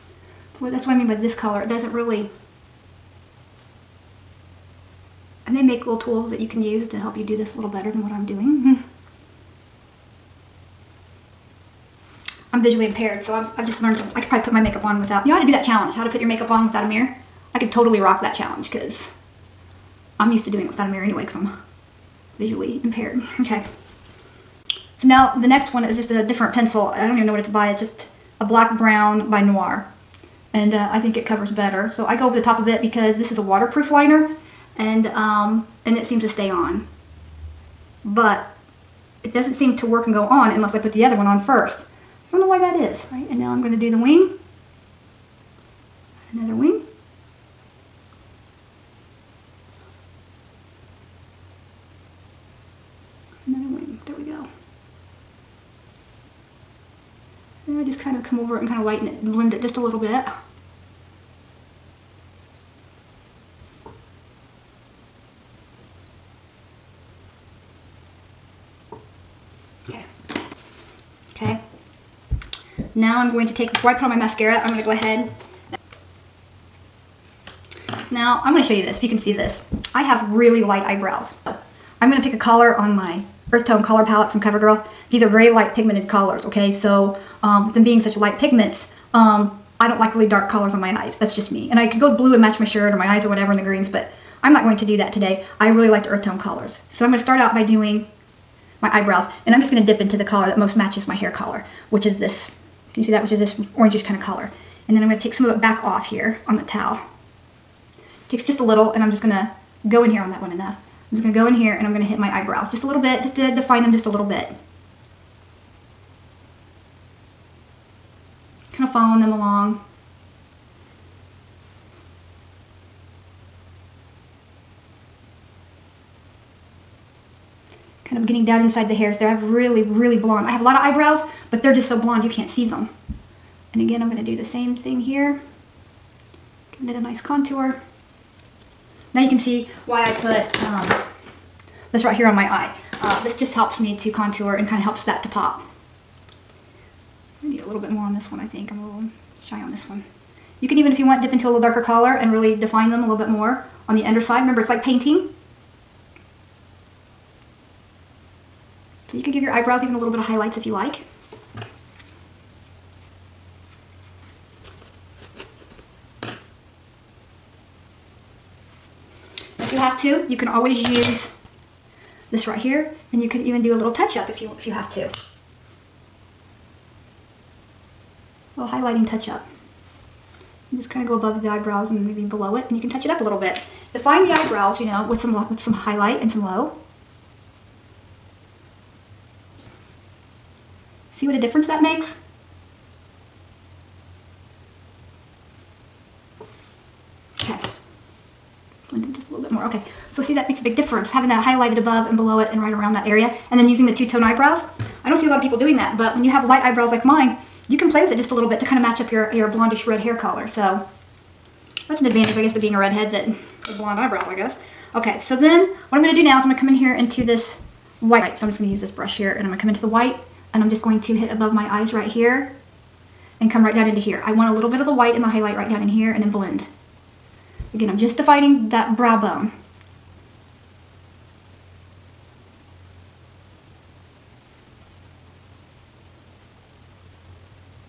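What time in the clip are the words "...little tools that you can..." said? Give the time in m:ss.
0:05.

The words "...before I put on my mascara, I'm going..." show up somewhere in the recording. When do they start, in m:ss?
1:13.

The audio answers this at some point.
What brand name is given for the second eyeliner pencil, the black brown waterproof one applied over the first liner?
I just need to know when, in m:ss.
0:29.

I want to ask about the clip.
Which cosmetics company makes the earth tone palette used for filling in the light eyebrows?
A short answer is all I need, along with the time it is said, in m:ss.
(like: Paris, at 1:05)
CoverGirl, at 1:24.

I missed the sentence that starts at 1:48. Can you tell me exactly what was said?
Takes just a little and I'm just going to go in here on that one enough.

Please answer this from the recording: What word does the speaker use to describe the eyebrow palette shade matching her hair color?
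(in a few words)
orangish.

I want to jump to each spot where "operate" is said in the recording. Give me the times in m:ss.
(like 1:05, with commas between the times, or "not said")
not said.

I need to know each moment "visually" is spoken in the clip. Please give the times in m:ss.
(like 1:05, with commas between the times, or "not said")
0:12, 0:22.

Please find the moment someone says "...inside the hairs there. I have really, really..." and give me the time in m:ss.
2:08.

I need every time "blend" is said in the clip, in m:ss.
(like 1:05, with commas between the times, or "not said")
0:59, 3:18, 3:46.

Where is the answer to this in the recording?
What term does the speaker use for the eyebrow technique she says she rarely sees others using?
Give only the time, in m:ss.
3:23.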